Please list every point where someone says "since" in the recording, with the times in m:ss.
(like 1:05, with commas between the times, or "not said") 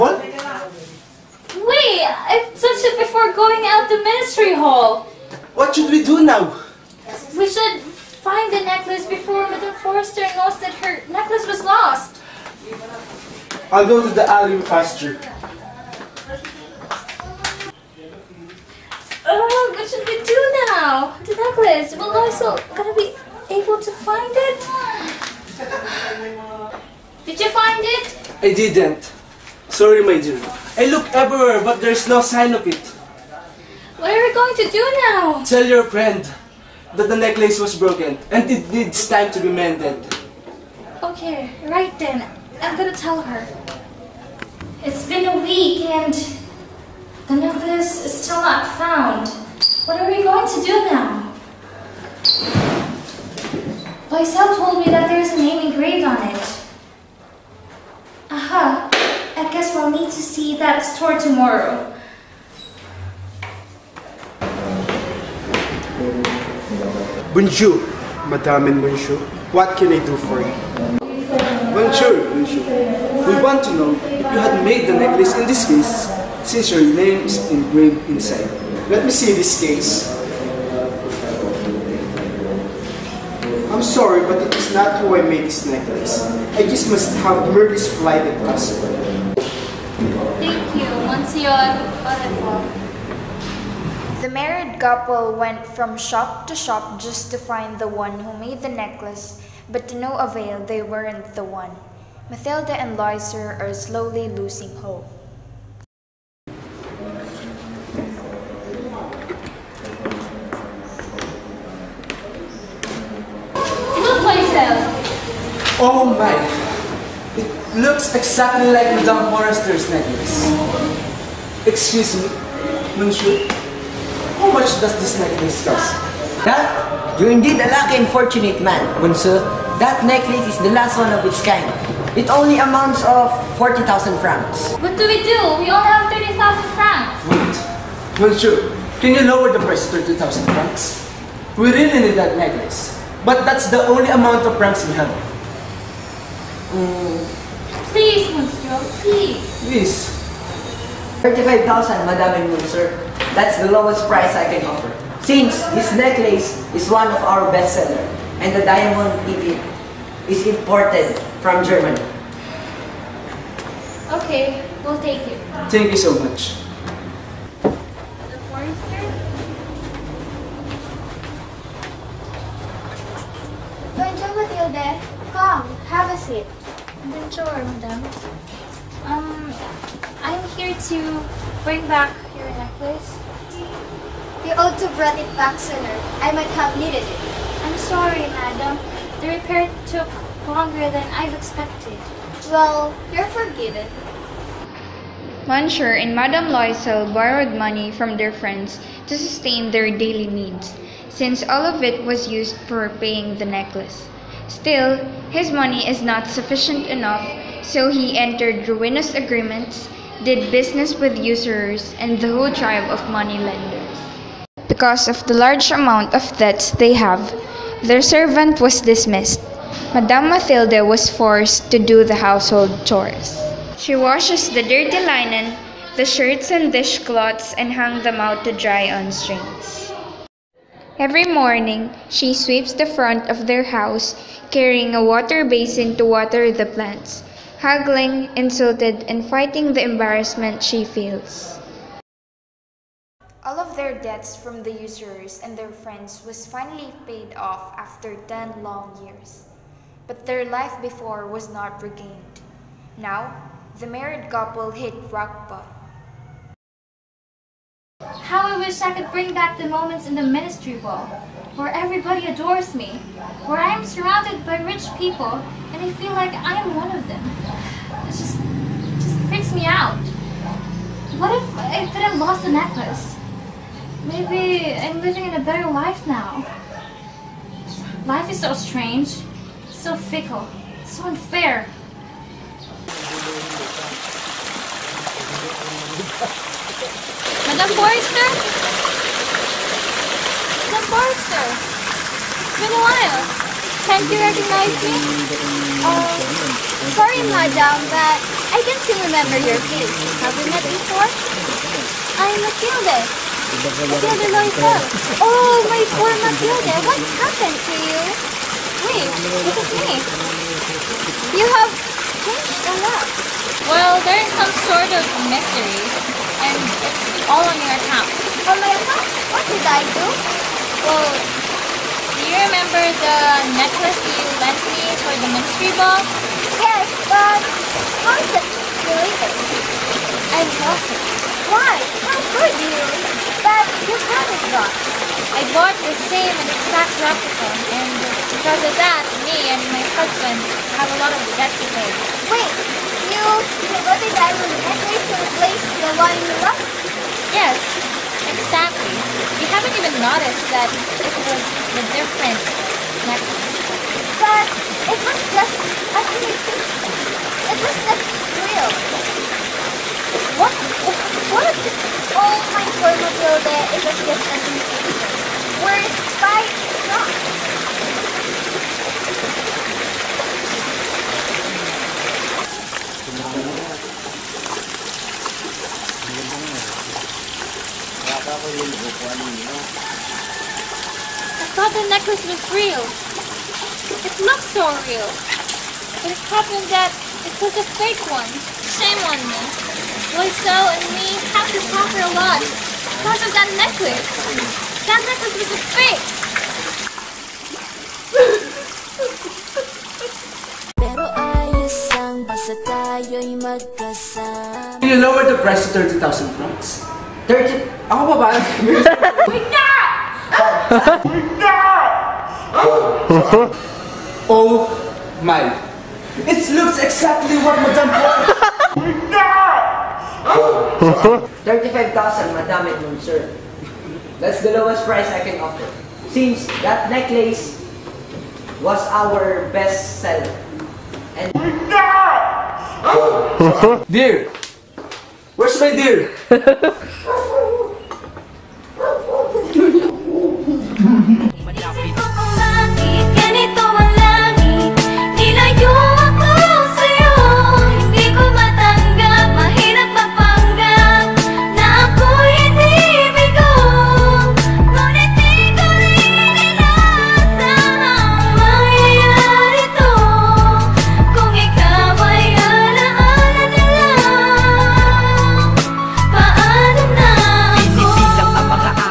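1:16, 2:35, 3:21, 7:06.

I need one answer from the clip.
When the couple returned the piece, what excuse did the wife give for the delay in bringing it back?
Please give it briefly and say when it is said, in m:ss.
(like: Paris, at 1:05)
The repair took longer, at 3:09.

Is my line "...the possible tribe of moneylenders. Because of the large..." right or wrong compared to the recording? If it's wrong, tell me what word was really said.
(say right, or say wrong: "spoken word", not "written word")
wrong: "whole", not "possible".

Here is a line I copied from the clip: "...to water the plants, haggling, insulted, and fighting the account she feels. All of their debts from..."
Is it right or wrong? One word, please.
wrong.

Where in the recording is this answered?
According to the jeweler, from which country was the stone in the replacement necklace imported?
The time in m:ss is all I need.
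2:41.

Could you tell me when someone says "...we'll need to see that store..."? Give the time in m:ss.
0:59.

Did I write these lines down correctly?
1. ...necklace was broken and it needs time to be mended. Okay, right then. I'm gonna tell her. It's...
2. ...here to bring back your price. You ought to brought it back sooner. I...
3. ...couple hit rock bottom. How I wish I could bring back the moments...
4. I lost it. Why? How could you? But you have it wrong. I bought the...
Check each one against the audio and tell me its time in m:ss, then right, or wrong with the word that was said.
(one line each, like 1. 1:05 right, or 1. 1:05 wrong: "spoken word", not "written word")
1. 0:37 right
2. 3:00 wrong: "necklace", not "price"
3. 4:14 right
4. 5:30 right.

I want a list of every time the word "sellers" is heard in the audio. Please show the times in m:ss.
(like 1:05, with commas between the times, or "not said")
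2:37, 7:10.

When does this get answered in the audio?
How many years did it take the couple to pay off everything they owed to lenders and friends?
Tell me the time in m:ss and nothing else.
4:08.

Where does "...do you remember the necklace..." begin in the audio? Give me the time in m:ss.
5:22.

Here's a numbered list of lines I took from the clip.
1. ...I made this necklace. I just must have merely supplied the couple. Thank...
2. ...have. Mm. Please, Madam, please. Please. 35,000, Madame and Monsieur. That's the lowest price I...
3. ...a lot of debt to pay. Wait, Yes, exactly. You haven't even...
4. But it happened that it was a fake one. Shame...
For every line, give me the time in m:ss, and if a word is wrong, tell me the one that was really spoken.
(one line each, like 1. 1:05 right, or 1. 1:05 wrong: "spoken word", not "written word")
1. 1:25 wrong: "possible", not "couple"
2. 2:24 wrong: "Monsieur", not "Madam"
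3. 5:40 right
4. 6:26 right.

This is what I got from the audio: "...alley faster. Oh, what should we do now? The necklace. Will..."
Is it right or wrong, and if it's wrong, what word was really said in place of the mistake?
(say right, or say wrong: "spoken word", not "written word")
right.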